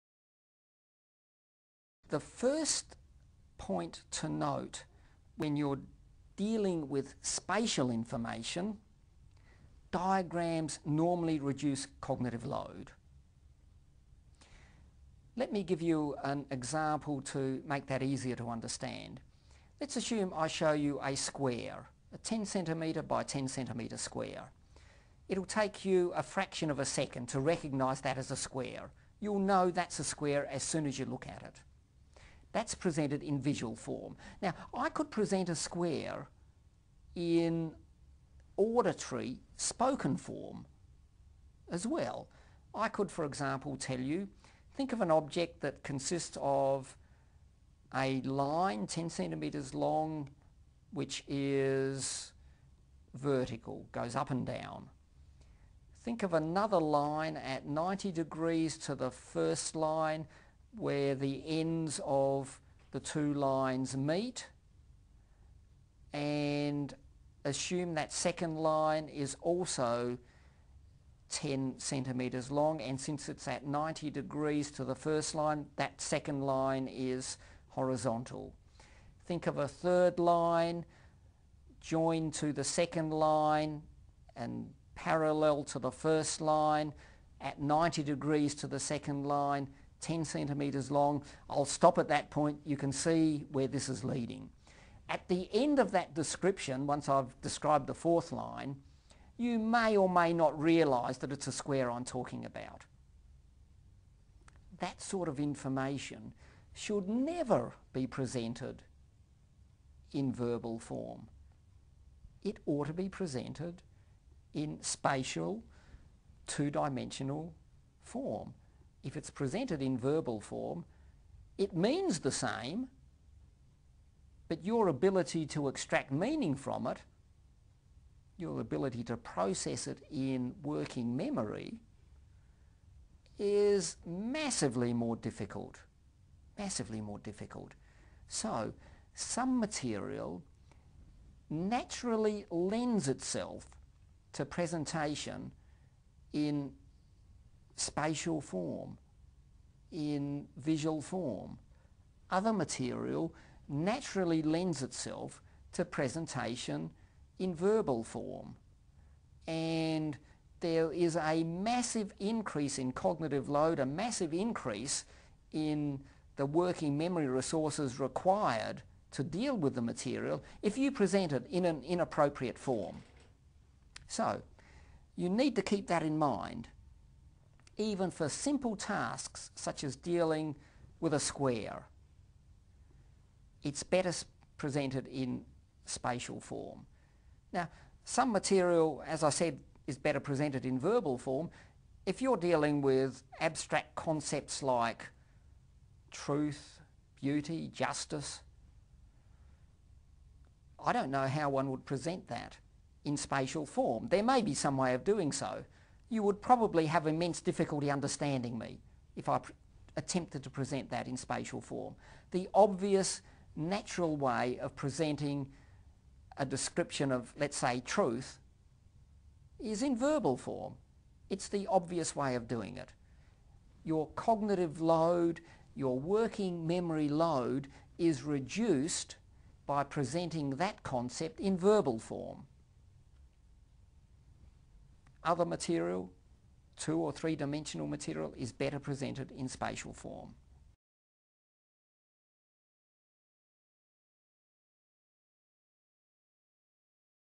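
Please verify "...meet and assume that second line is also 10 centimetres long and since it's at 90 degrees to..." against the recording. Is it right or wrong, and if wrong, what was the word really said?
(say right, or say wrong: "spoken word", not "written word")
right.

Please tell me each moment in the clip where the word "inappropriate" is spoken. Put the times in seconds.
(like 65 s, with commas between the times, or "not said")
171 s.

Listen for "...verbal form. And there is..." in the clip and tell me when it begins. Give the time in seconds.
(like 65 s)
157 s.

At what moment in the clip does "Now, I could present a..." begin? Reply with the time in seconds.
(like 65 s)
34 s.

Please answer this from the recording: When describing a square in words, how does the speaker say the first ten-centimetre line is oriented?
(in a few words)
vertical.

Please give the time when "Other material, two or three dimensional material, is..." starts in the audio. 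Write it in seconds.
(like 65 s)
235 s.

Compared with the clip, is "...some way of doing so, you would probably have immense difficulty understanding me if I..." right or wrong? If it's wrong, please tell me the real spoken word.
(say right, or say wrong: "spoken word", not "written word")
right.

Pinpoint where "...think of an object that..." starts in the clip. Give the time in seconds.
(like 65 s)
44 s.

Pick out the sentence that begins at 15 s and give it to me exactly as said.
Let me give you an example to make that easier to understand.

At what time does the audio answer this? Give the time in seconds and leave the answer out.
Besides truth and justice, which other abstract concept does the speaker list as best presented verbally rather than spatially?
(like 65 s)
197 s.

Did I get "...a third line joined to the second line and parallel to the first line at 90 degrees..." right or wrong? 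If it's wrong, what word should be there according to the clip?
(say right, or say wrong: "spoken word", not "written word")
right.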